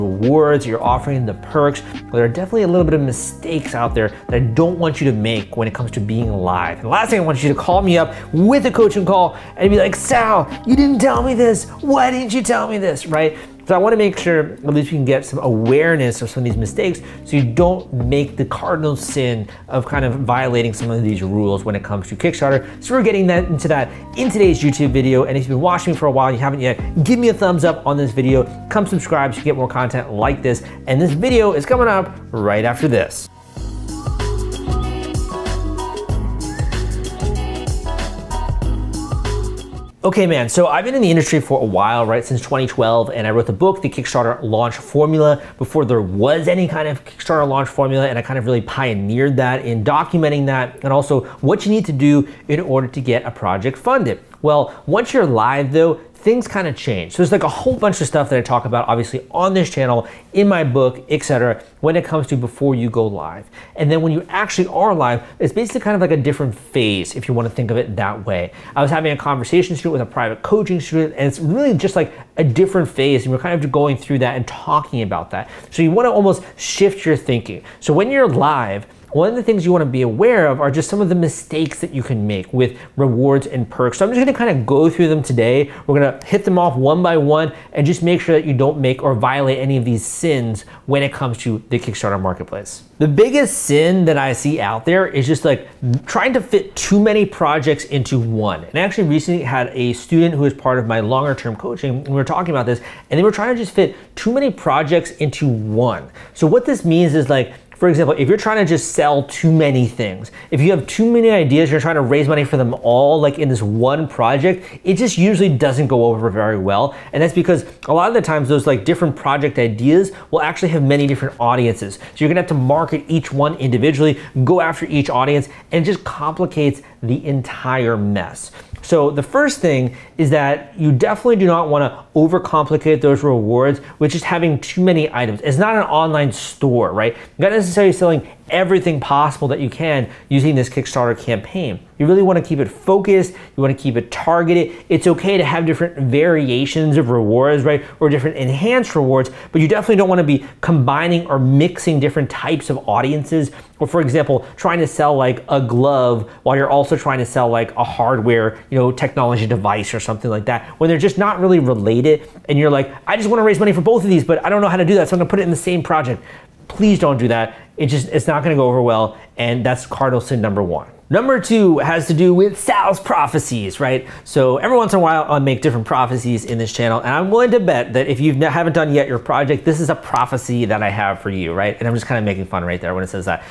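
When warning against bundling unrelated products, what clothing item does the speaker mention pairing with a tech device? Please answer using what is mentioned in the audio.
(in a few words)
a glove.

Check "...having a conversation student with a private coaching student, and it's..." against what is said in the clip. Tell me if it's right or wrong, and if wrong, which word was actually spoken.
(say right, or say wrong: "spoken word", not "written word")
right.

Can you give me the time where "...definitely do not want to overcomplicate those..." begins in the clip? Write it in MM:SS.
02:10.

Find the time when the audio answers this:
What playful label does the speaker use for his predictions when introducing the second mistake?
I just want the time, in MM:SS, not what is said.
02:52.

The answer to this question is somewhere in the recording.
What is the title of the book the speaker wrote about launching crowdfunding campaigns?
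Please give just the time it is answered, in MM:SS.
00:43.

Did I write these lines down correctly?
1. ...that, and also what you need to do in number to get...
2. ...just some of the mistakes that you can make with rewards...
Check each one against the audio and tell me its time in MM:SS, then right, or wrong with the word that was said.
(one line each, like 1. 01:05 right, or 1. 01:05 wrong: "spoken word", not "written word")
1. 00:50 wrong: "order", not "number"
2. 01:20 right.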